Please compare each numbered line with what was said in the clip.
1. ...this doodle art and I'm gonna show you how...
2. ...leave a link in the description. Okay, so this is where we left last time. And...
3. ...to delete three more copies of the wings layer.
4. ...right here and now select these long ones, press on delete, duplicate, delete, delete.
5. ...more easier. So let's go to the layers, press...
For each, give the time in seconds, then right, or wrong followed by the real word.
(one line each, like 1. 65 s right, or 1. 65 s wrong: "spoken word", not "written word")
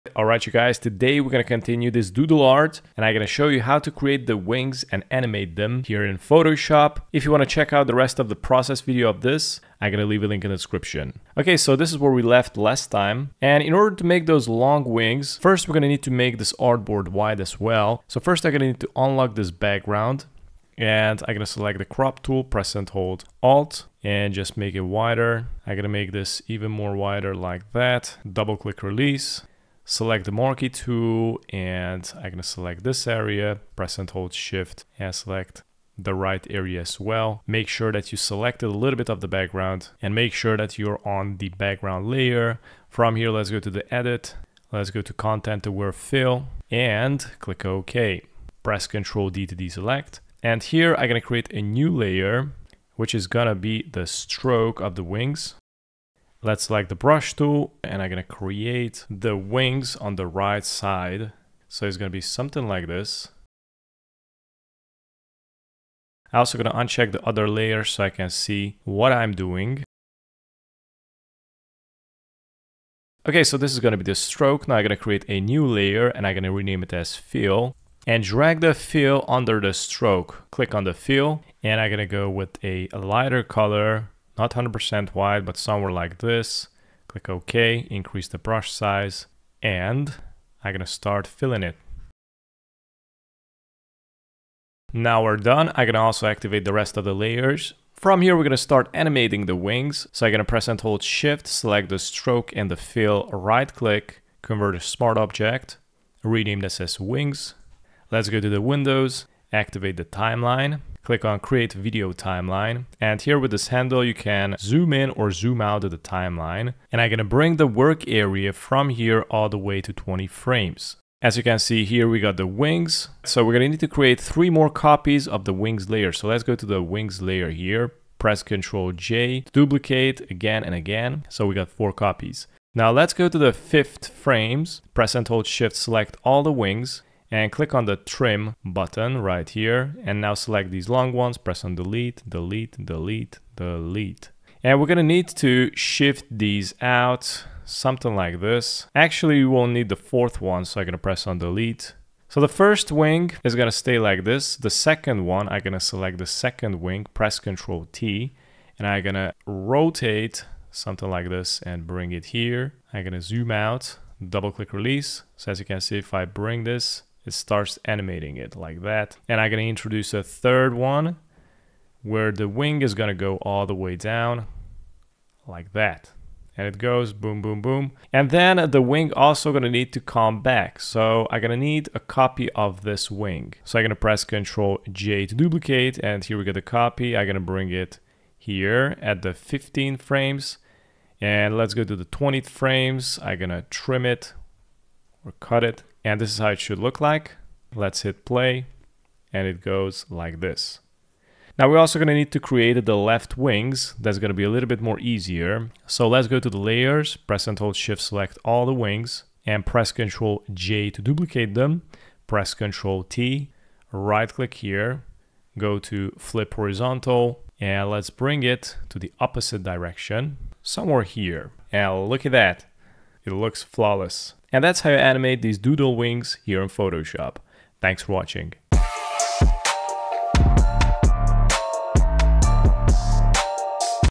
1. 1 s right
2. 10 s right
3. 123 s wrong: "create", not "delete"
4. 139 s wrong: "delete", not "duplicate"
5. 204 s right.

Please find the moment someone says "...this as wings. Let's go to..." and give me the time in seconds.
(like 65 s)
106 s.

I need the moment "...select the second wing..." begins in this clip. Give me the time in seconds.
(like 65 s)
155 s.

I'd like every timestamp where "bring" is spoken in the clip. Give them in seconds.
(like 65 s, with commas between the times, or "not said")
117 s, 161 s, 166 s, 187 s, 218 s.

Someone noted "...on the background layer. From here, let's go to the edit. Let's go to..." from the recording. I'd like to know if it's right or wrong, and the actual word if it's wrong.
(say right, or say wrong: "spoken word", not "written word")
right.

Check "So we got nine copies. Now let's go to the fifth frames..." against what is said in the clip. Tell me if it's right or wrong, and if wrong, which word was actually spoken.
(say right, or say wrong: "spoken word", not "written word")
wrong: "four", not "nine".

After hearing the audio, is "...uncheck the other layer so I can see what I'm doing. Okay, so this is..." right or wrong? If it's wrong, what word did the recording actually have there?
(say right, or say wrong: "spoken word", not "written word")
right.